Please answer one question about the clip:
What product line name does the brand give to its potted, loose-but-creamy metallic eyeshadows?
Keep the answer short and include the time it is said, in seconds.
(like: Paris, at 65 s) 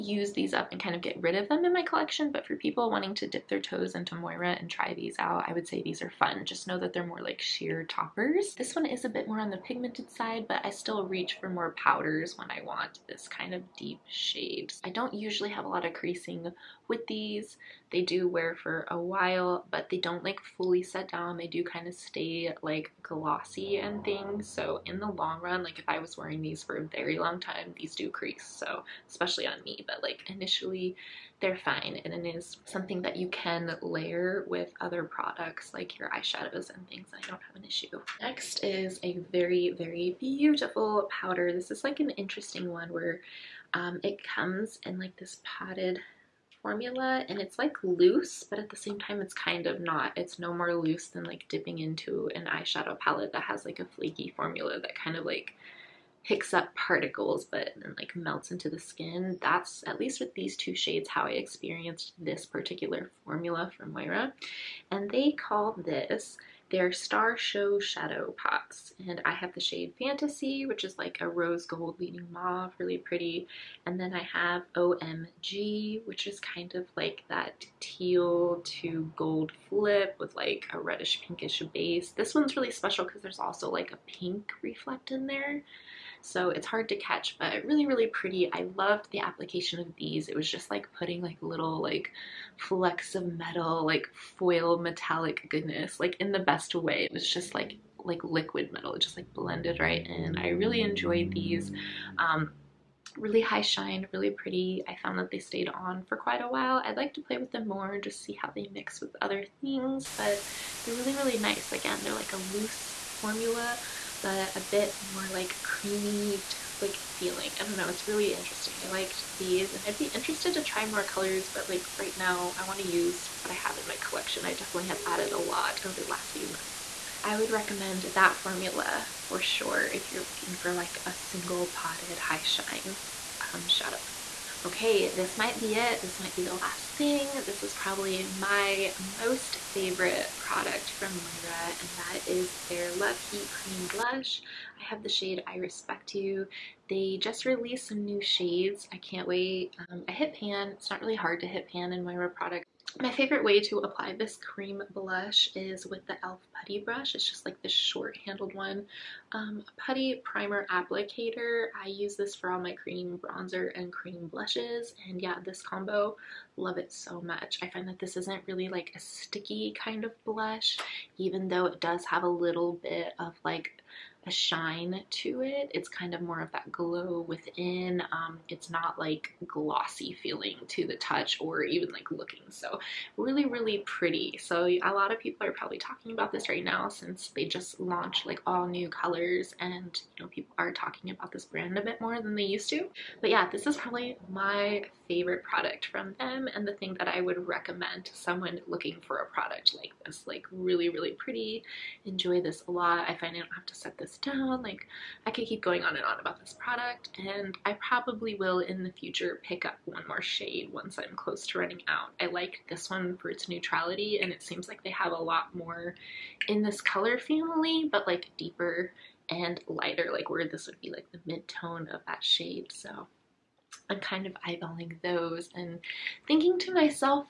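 Star Show Shadow Pots, at 66 s.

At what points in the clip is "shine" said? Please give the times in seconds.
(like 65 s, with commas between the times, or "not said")
103 s, 132 s, 174 s.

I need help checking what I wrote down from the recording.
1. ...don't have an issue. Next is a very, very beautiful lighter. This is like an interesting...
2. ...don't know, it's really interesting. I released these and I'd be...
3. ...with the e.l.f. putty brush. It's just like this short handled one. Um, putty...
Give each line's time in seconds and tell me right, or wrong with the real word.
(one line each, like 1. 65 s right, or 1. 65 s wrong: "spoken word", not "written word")
1. 37 s wrong: "powder", not "lighter"
2. 117 s wrong: "liked", not "released"
3. 155 s right.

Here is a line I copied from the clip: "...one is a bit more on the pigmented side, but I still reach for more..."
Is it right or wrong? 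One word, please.
right.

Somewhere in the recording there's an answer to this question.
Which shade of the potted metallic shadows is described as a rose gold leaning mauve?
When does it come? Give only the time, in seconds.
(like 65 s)
69 s.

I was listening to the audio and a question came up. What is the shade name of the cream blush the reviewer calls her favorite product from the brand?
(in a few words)
I Respect You.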